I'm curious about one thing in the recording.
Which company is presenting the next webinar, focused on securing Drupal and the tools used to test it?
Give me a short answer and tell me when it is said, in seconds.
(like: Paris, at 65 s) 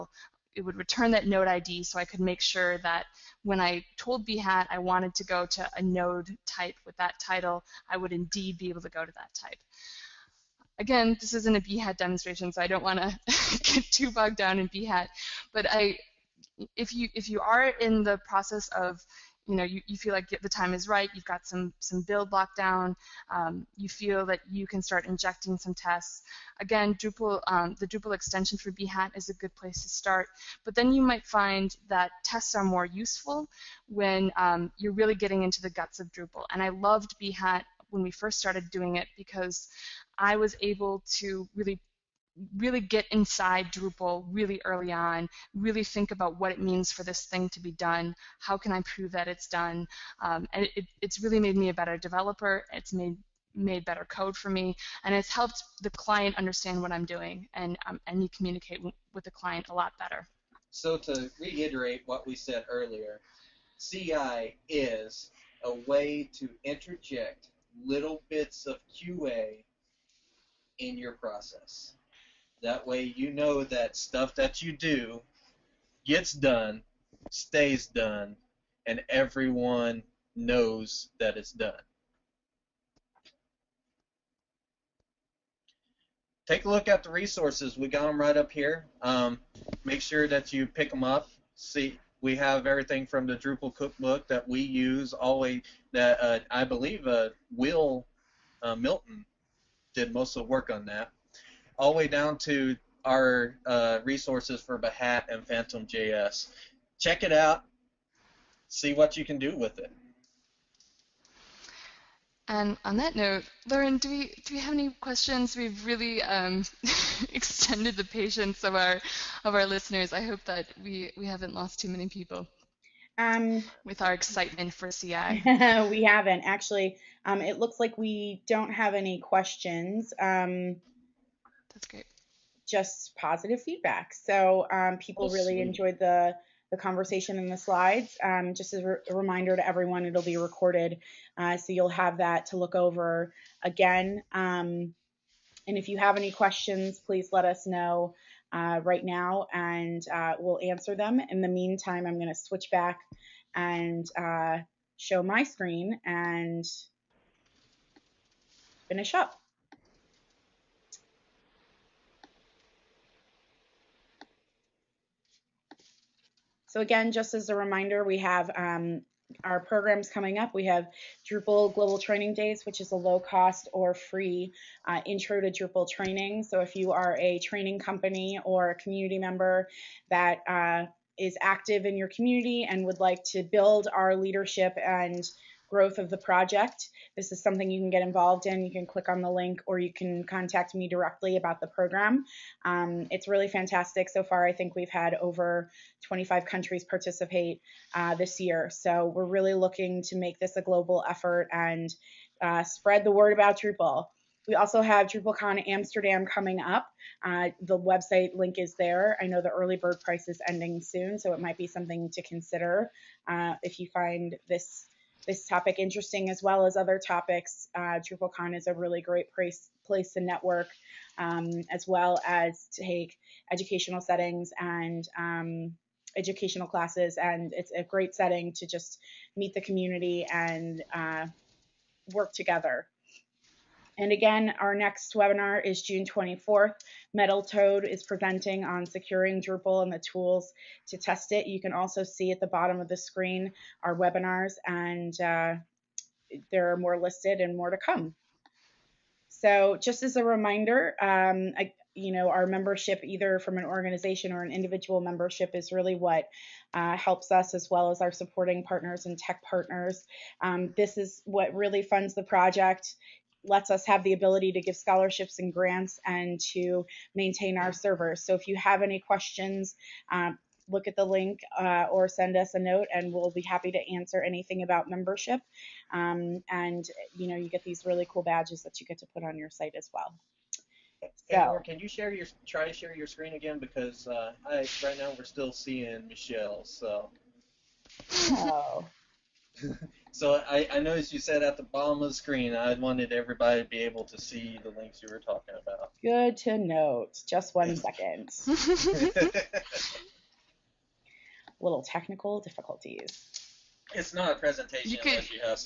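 Metal Toad, at 237 s.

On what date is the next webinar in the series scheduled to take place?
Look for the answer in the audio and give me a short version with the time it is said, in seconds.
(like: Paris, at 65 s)
June 24th, at 235 s.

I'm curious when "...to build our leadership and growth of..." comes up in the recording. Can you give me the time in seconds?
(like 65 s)
183 s.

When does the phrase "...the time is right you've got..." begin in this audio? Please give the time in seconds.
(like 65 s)
20 s.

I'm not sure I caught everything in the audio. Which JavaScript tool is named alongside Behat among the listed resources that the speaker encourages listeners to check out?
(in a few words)
Phantom JS.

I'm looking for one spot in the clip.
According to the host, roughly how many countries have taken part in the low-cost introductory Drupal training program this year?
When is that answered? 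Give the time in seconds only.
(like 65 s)
195 s.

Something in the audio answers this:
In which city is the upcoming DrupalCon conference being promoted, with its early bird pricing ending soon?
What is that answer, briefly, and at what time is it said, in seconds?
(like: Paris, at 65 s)
Amsterdam, at 205 s.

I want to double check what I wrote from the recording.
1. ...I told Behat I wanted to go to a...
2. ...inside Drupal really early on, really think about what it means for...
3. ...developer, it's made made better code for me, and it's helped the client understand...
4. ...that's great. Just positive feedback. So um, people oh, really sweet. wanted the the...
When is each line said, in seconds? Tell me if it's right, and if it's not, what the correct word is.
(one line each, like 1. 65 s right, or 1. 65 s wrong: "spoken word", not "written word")
1. 3 s right
2. 43 s right
3. 51 s right
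4. 131 s wrong: "enjoyed", not "wanted".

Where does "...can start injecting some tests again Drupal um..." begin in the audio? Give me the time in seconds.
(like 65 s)
24 s.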